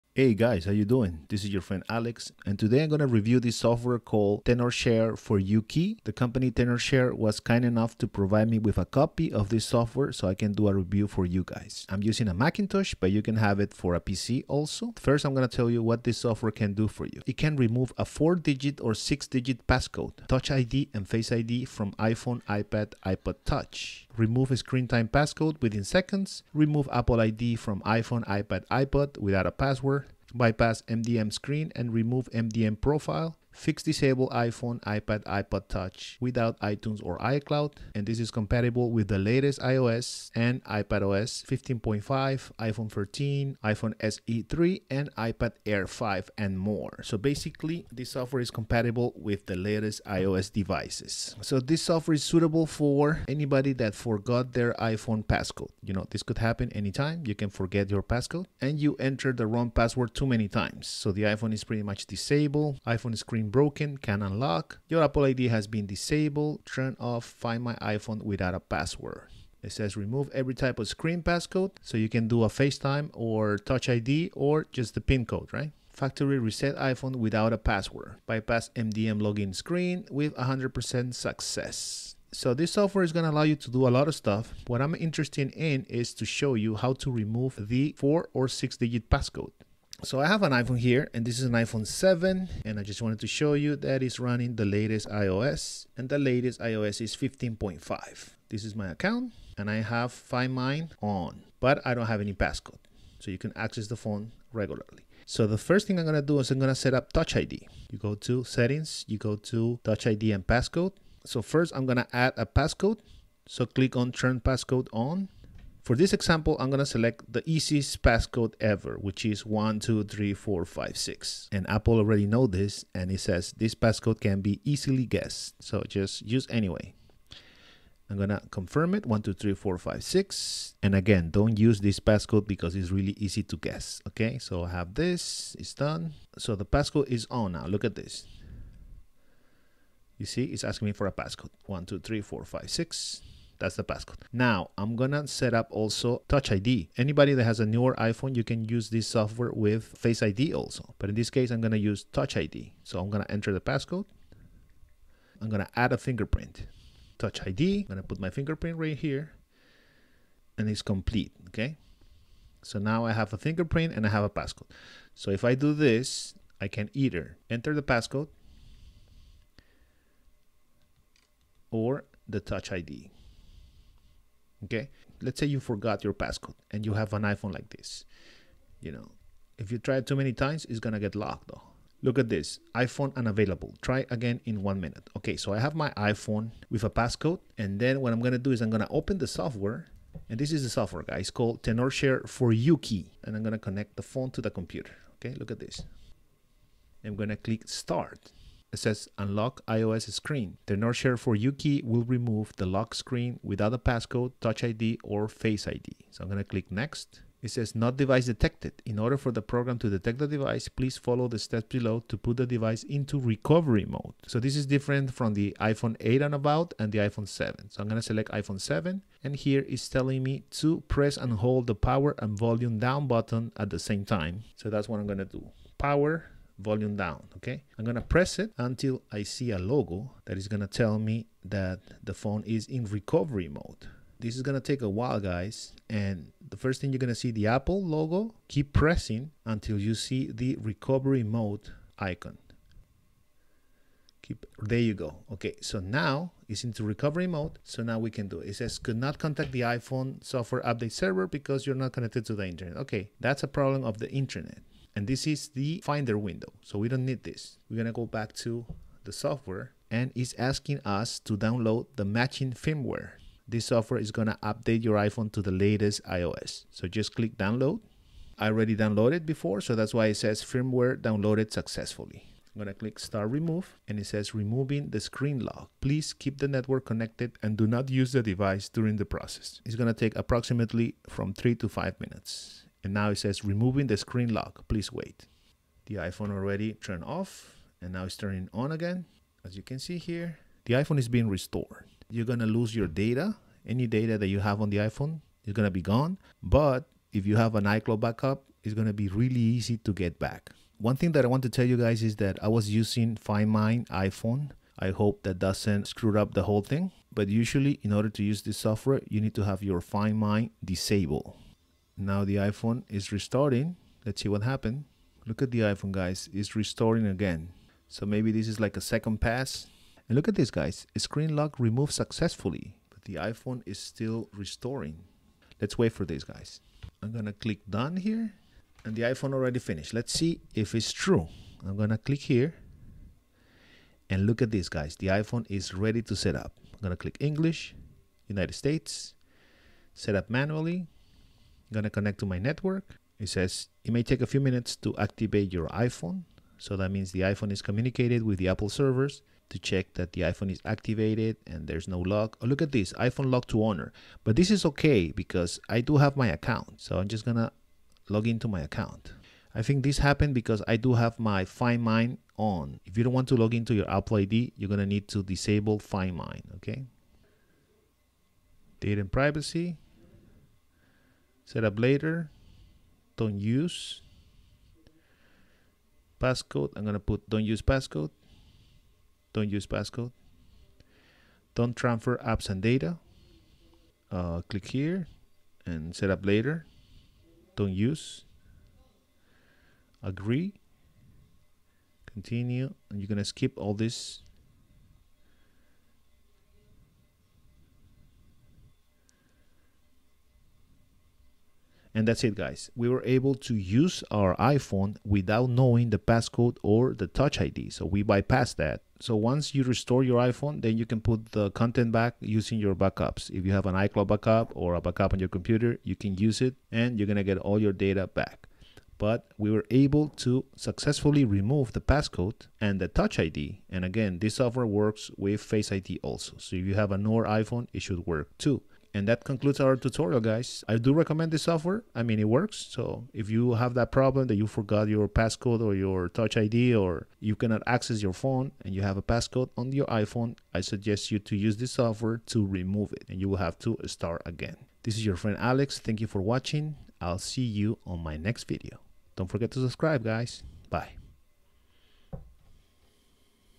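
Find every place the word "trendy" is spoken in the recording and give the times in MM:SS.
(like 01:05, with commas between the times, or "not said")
not said.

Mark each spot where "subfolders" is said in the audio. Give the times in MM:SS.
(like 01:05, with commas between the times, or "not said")
not said.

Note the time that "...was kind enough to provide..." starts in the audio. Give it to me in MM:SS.
00:07.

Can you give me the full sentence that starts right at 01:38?
This is my account and I have Find My on, but I don't have any passcode.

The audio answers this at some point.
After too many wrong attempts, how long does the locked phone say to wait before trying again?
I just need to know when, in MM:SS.
03:04.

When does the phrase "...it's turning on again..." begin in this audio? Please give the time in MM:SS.
04:48.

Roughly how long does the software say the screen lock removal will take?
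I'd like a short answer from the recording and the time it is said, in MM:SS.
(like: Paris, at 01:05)
3 to 5 minutes, at 04:41.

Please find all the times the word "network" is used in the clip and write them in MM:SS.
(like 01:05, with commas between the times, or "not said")
04:36, 05:42.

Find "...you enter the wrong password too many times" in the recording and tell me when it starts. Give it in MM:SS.
00:58.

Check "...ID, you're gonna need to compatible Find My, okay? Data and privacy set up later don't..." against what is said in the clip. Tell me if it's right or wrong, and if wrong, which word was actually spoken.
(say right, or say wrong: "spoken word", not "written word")
wrong: "disable", not "compatible".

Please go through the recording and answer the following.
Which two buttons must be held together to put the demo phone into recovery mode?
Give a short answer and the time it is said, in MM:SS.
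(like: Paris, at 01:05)
Power and volume down, at 03:41.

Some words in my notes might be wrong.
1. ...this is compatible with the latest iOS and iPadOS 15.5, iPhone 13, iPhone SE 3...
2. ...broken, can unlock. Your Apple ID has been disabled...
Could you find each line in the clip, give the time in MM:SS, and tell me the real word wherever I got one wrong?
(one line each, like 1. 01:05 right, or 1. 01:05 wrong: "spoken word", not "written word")
1. 00:38 right
2. 01:03 right.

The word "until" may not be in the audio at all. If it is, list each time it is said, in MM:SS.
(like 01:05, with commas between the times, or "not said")
03:48, 03:59.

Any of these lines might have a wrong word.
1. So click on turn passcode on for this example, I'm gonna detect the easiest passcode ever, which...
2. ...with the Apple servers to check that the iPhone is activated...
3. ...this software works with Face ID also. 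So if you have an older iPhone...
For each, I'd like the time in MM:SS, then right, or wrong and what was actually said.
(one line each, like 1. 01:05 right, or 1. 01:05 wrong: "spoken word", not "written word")
1. 01:53 wrong: "select", not "detect"
2. 05:48 right
3. 07:04 right.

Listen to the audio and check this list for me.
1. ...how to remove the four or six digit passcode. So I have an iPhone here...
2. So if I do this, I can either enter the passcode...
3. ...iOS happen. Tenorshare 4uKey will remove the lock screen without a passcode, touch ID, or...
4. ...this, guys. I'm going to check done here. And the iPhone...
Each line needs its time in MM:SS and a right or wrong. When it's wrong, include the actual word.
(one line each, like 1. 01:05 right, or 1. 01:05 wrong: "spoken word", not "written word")
1. 01:26 right
2. 02:45 right
3. 03:19 wrong: "screen", not "happen"
4. 05:26 wrong: "click", not "check".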